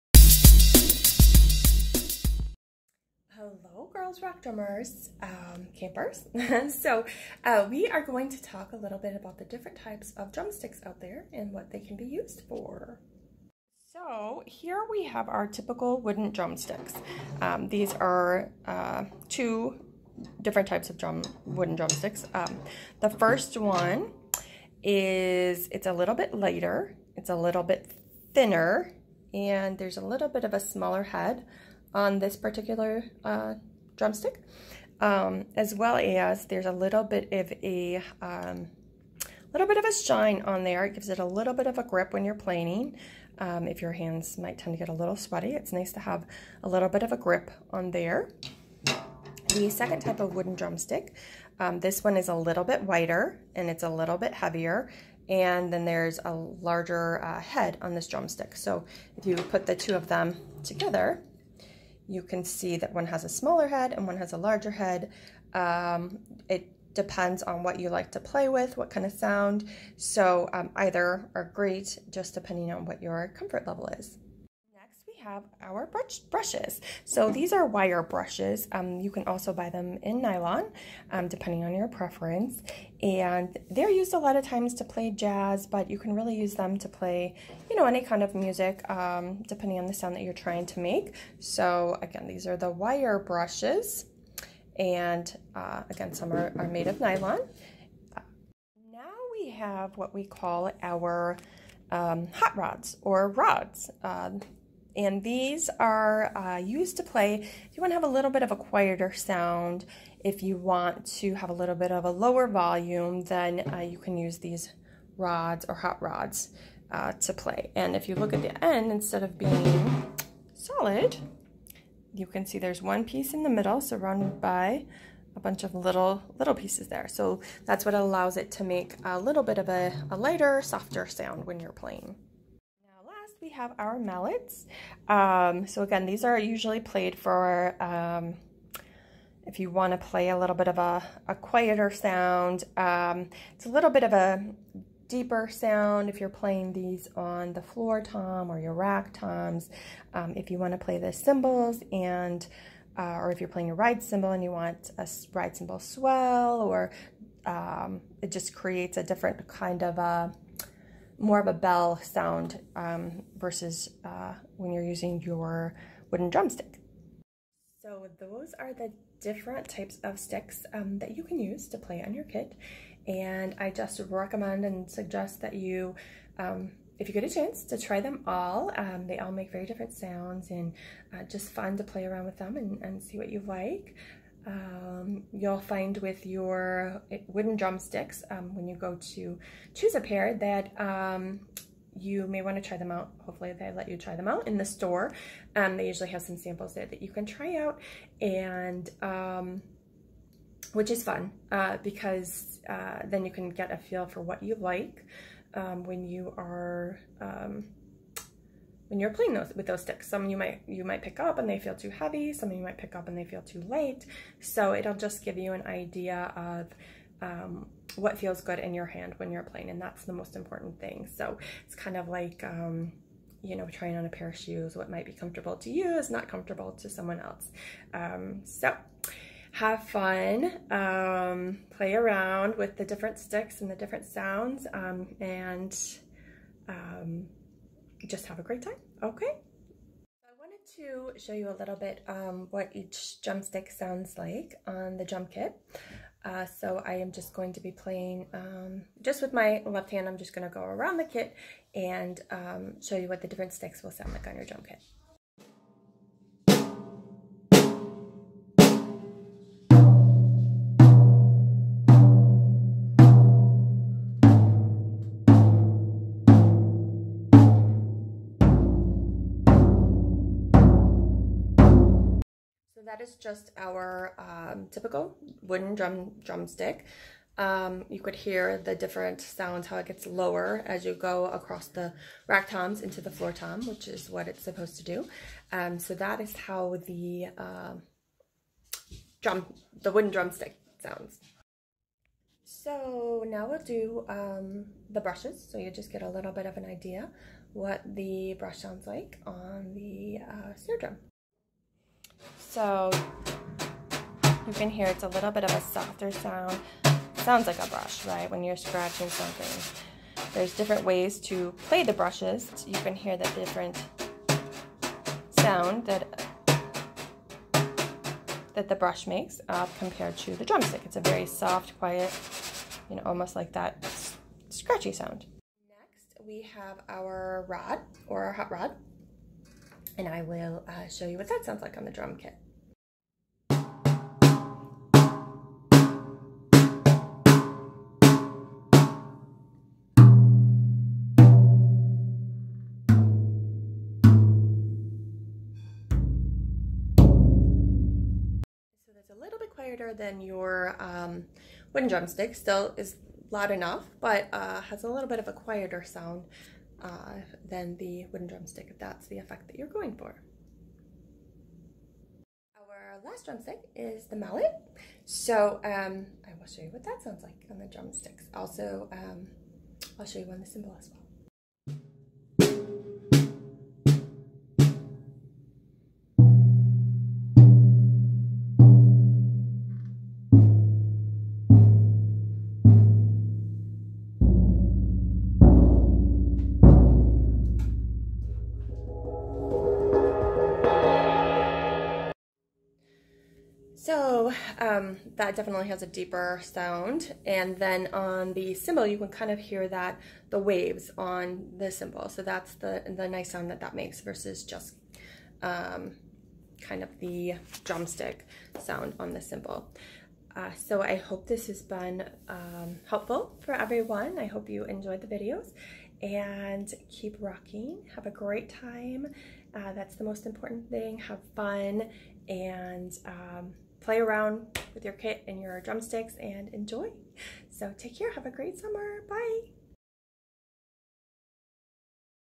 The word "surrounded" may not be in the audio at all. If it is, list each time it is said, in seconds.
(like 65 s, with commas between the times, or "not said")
123 s.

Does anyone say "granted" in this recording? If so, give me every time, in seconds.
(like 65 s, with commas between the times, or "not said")
not said.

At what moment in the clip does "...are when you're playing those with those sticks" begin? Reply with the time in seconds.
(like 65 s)
206 s.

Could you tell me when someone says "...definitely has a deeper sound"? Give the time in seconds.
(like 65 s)
395 s.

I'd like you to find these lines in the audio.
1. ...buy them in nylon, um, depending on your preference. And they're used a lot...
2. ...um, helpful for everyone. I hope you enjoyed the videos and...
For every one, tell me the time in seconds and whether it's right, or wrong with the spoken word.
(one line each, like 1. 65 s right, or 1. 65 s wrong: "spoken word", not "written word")
1. 79 s right
2. 412 s right.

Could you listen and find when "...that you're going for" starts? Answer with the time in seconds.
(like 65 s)
359 s.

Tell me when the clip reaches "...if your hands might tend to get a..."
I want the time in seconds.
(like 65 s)
43 s.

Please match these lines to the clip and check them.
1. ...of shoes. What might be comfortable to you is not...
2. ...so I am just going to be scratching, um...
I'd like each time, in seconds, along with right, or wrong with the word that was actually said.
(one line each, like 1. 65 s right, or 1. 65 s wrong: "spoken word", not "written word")
1. 224 s right
2. 246 s wrong: "playing", not "scratching".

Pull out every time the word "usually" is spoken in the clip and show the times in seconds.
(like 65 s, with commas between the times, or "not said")
136 s, 195 s.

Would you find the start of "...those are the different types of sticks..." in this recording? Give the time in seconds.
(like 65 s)
168 s.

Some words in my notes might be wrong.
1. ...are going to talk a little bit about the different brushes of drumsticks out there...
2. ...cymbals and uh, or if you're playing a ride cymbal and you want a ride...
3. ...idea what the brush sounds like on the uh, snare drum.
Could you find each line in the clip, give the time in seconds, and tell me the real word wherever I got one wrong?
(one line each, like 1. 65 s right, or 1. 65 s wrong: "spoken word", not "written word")
1. 7 s wrong: "types", not "brushes"
2. 151 s right
3. 296 s right.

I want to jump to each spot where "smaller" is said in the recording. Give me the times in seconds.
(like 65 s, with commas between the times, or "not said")
30 s, 63 s.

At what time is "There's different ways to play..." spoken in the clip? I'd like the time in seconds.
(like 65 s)
310 s.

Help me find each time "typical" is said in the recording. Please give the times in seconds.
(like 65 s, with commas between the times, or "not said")
15 s, 274 s.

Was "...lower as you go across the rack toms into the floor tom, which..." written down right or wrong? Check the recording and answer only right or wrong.
right.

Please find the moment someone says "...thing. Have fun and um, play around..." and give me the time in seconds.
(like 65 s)
420 s.